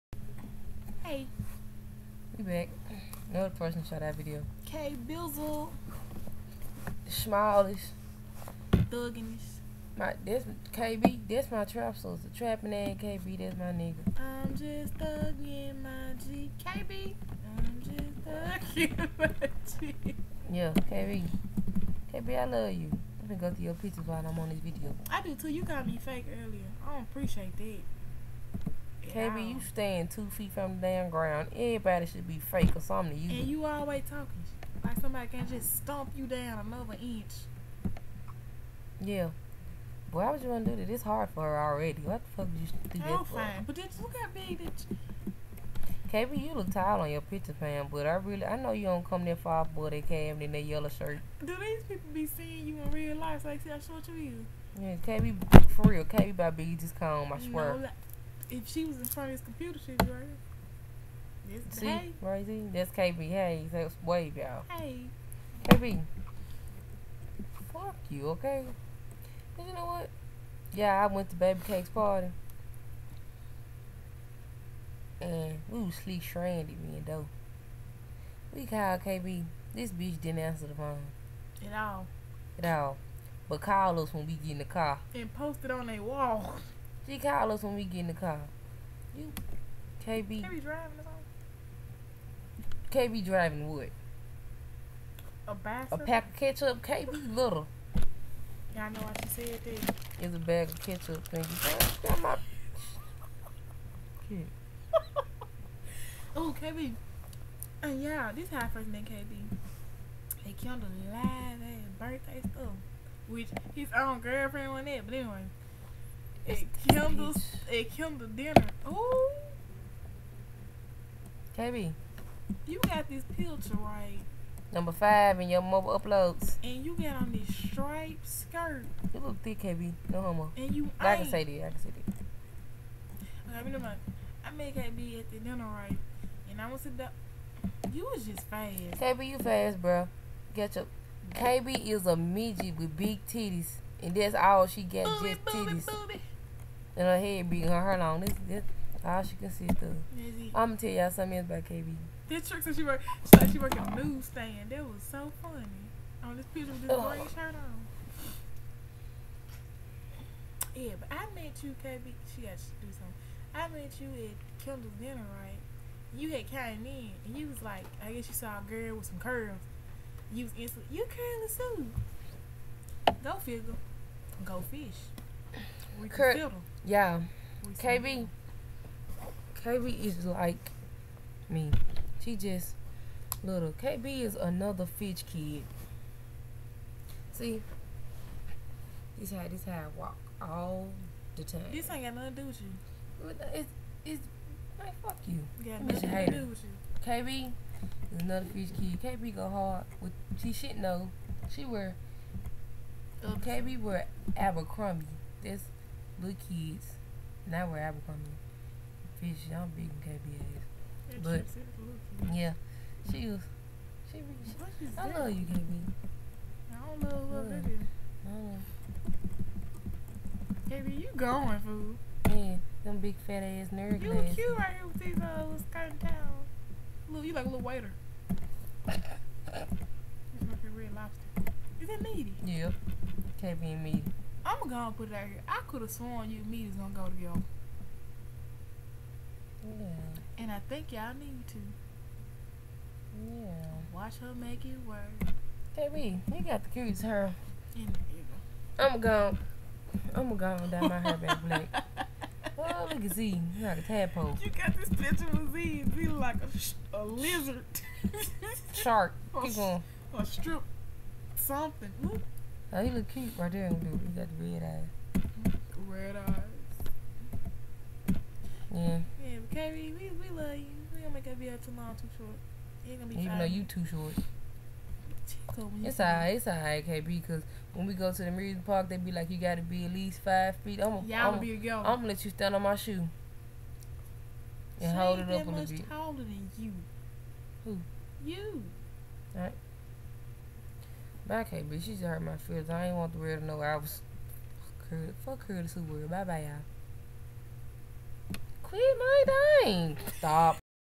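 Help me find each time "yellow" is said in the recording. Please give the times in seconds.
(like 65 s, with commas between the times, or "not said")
50 s.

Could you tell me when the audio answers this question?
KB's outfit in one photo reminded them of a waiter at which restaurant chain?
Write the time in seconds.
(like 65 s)
230 s.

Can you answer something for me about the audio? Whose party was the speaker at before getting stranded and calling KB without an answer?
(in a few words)
Baby Cake's party.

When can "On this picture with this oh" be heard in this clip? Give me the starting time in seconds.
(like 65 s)
156 s.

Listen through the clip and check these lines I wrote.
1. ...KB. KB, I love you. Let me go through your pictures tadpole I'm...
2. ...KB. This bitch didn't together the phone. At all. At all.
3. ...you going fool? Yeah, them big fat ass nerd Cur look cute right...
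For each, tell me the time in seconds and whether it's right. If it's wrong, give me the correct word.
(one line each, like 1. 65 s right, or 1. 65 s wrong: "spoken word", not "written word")
1. 20 s wrong: "while", not "tadpole"
2. 79 s wrong: "answer", not "together"
3. 221 s wrong: "You", not "Cur".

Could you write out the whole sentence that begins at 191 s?
This ain't got nothing to do with you.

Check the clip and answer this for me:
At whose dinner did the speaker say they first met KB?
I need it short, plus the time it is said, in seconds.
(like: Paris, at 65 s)
Kendall's dinner, at 164 s.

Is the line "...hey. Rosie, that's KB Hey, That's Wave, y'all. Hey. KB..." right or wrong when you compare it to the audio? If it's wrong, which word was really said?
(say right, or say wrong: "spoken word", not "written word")
right.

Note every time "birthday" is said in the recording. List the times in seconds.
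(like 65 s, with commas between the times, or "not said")
111 s.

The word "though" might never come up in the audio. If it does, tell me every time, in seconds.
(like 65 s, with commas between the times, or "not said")
273 s.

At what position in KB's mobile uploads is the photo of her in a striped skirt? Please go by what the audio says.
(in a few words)
Number five.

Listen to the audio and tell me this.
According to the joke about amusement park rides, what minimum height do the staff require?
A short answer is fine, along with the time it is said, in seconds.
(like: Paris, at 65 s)
5 feet, at 280 s.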